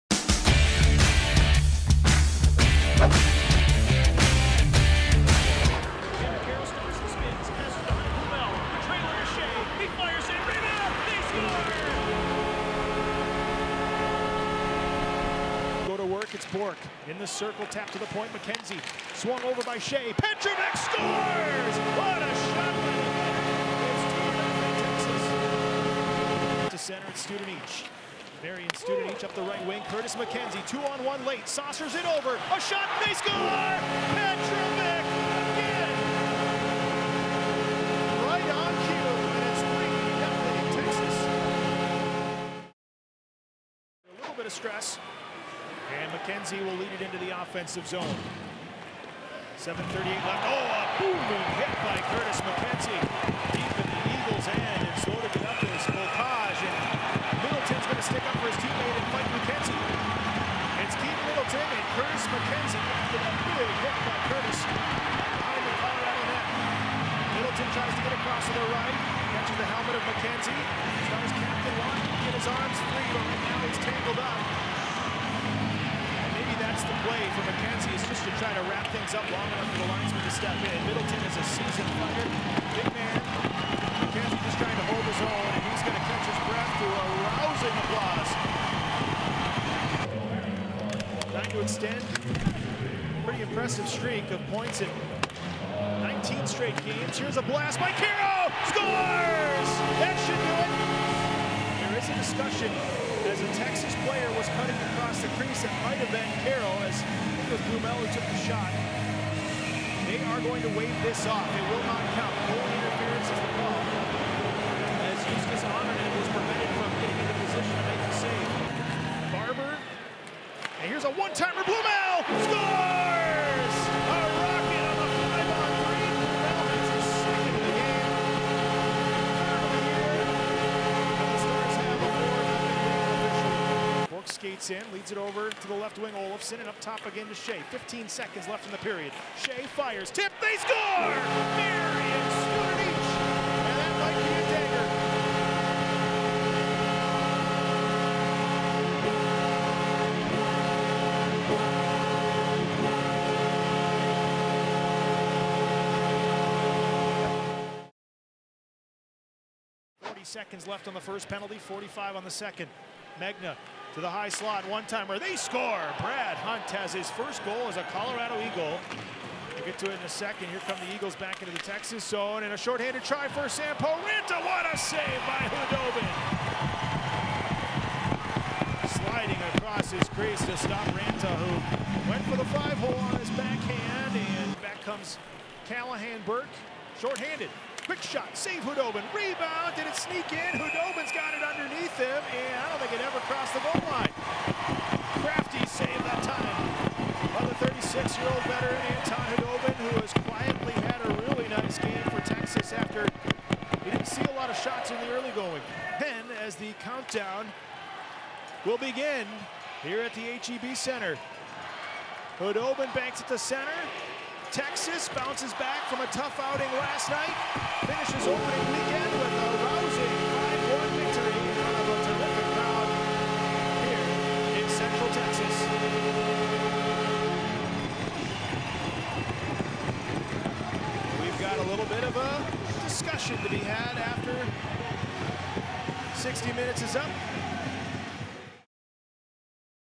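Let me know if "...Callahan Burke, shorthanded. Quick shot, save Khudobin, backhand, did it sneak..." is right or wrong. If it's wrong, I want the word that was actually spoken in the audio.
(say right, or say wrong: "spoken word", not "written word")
wrong: "rebound", not "backhand".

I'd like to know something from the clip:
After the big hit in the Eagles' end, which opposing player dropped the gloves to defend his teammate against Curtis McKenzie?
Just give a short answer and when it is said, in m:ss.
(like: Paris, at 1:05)
Keaton Middleton, at 1:00.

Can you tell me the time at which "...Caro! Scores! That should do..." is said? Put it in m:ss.
1:37.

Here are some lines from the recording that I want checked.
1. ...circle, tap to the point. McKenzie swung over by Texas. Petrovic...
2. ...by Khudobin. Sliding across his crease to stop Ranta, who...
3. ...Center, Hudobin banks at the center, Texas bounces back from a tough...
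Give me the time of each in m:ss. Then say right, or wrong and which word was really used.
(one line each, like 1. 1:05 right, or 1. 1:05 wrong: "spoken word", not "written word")
1. 0:17 wrong: "Shea", not "Texas"
2. 2:55 right
3. 3:30 right.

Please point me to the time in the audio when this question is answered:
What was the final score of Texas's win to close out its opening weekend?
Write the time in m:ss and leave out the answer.
3:40.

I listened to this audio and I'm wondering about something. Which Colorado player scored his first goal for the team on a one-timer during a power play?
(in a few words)
Brad Hunt.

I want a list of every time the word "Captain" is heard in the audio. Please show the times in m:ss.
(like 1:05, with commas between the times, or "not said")
1:11.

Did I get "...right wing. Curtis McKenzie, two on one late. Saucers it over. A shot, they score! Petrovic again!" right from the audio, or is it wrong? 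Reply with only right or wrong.
right.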